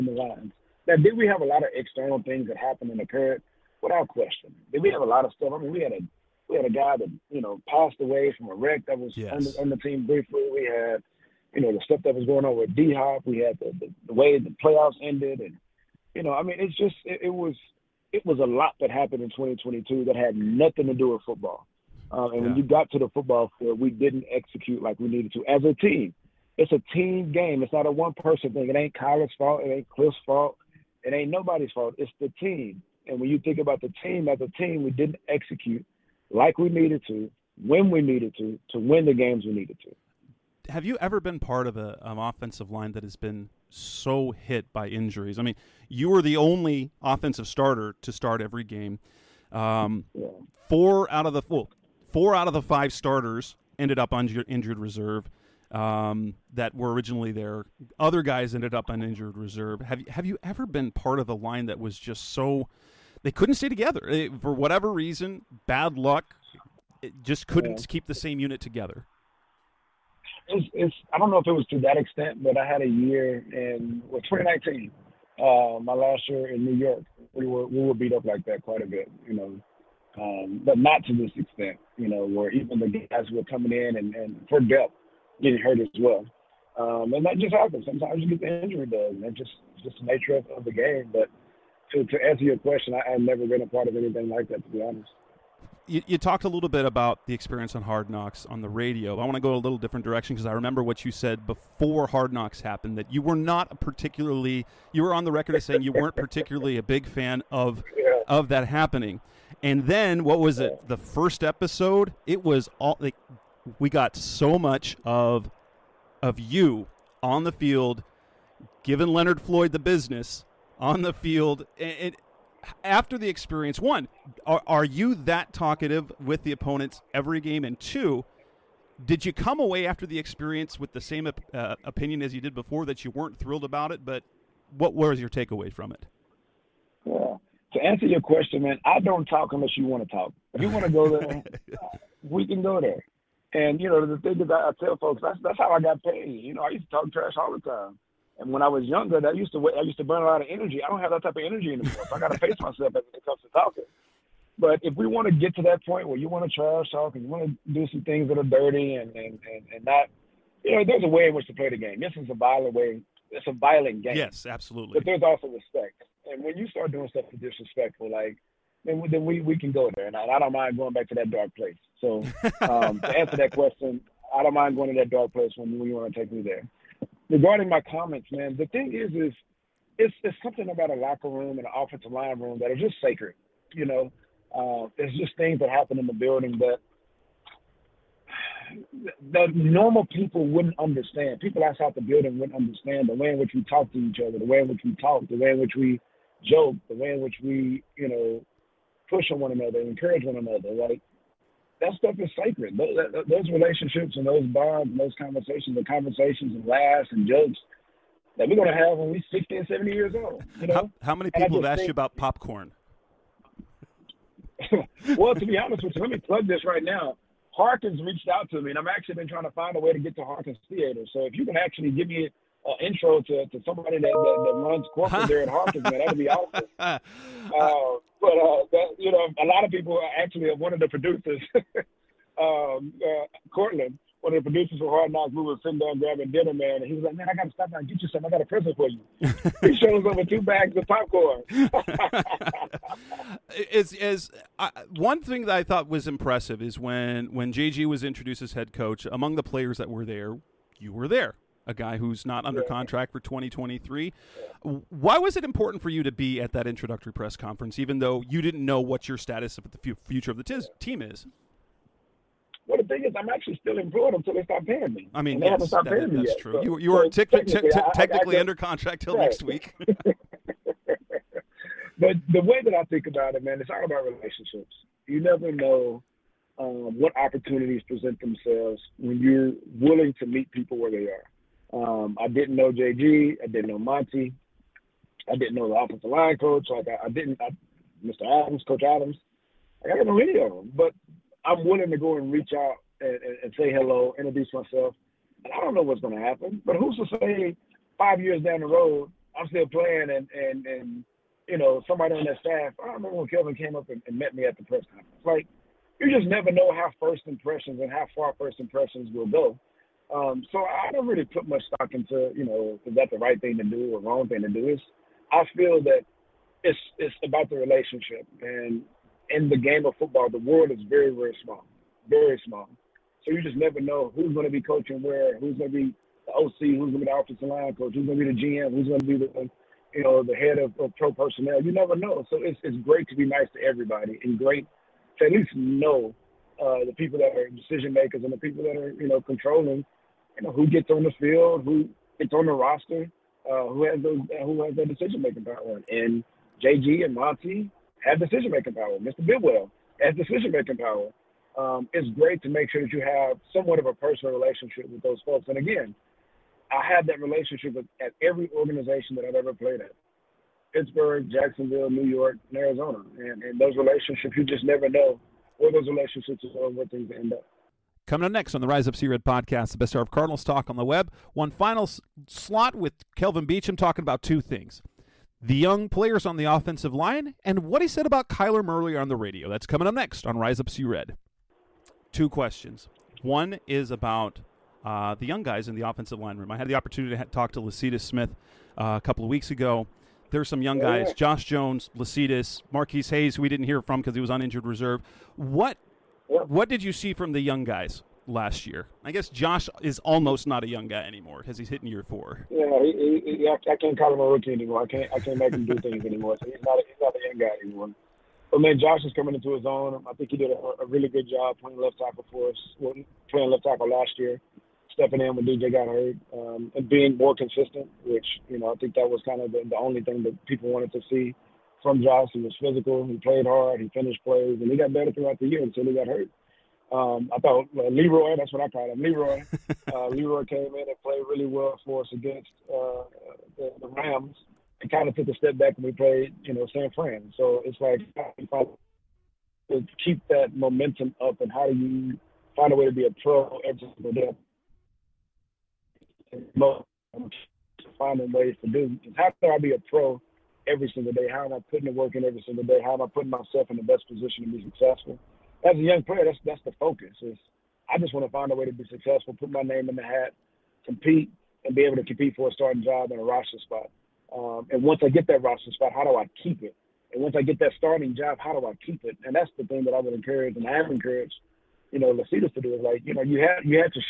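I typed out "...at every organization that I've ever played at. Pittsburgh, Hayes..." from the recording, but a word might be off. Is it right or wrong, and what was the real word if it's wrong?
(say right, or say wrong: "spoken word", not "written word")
wrong: "Jacksonville", not "Hayes".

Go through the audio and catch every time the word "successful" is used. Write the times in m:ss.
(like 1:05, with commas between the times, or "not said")
7:34, 7:38.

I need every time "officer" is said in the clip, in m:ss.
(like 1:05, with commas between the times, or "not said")
not said.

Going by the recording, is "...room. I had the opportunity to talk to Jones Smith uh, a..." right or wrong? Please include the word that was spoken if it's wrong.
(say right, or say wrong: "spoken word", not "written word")
wrong: "Lecitus", not "Jones".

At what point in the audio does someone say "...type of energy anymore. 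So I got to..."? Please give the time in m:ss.
2:31.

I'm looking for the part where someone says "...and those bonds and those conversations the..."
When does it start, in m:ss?
3:24.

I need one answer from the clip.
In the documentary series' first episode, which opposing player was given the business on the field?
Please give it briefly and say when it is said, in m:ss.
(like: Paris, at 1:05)
Leonard Floyd, at 1:59.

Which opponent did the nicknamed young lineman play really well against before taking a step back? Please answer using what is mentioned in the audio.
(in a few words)
the Rams.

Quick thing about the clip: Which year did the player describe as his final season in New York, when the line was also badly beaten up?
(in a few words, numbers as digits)
2019.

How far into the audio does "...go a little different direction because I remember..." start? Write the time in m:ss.
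1:39.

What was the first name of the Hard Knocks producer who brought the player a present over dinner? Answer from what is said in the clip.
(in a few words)
Cortland.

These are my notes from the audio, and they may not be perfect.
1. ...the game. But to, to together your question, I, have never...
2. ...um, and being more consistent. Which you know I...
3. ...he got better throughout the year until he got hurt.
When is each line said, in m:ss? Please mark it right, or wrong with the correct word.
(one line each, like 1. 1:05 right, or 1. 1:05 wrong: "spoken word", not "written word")
1. 1:30 wrong: "answer", not "together"
2. 6:56 right
3. 7:04 right.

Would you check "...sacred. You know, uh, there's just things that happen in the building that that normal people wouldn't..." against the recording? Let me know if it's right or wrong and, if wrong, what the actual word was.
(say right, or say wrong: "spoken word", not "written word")
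right.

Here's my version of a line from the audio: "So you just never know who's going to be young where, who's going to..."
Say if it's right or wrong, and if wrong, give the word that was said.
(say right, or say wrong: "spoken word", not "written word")
wrong: "coaching", not "young".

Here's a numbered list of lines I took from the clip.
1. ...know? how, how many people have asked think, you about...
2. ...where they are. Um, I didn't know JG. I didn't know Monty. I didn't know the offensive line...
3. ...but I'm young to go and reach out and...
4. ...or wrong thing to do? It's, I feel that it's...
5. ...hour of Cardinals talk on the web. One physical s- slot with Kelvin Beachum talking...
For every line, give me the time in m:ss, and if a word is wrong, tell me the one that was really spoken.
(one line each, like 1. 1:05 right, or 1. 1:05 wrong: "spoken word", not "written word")
1. 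3:30 right
2. 4:40 right
3. 4:50 wrong: "willing", not "young"
4. 5:13 right
5. 6:09 wrong: "final", not "physical".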